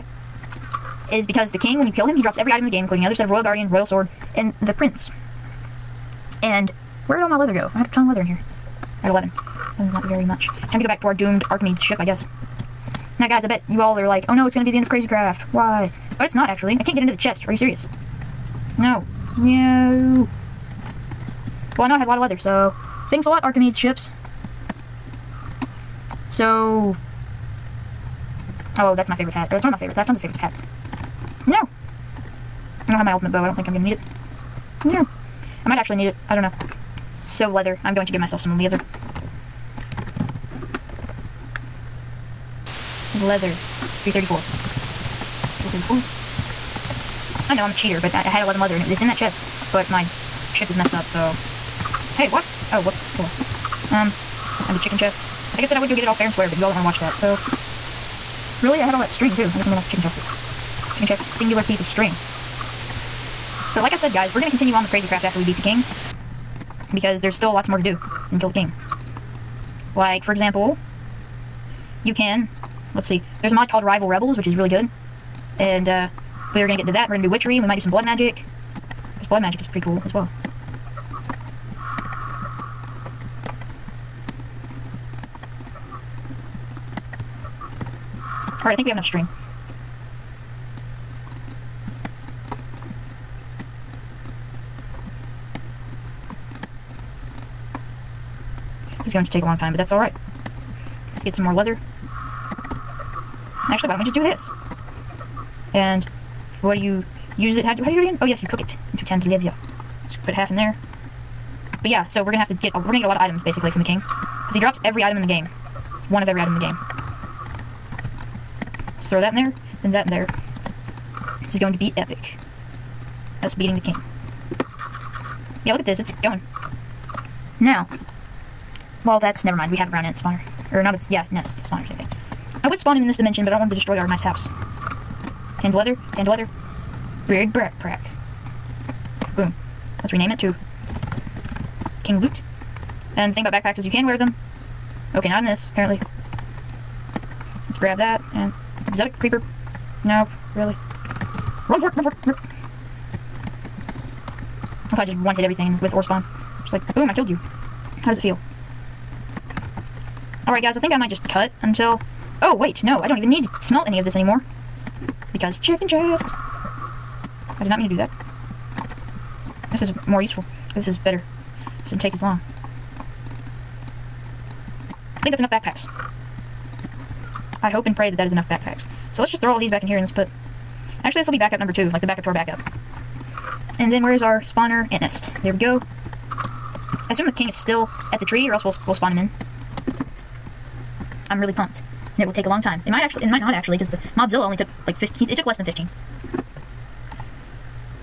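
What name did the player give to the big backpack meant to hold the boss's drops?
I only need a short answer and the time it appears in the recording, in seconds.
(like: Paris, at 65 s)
King Loot, at 142 s.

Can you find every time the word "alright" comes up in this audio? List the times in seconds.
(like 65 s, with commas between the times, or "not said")
88 s, 99 s, 160 s.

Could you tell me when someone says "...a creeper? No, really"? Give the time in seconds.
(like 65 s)
149 s.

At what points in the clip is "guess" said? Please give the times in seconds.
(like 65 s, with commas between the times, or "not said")
12 s, 59 s.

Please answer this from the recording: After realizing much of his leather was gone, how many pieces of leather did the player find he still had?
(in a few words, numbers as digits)
11.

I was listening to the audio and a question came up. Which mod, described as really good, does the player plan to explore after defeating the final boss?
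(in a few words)
Rival Rebels.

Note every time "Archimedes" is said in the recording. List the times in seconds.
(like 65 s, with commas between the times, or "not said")
11 s, 23 s.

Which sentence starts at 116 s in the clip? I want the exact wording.
One of every item in the game.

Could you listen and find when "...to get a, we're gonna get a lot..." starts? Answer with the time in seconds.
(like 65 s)
112 s.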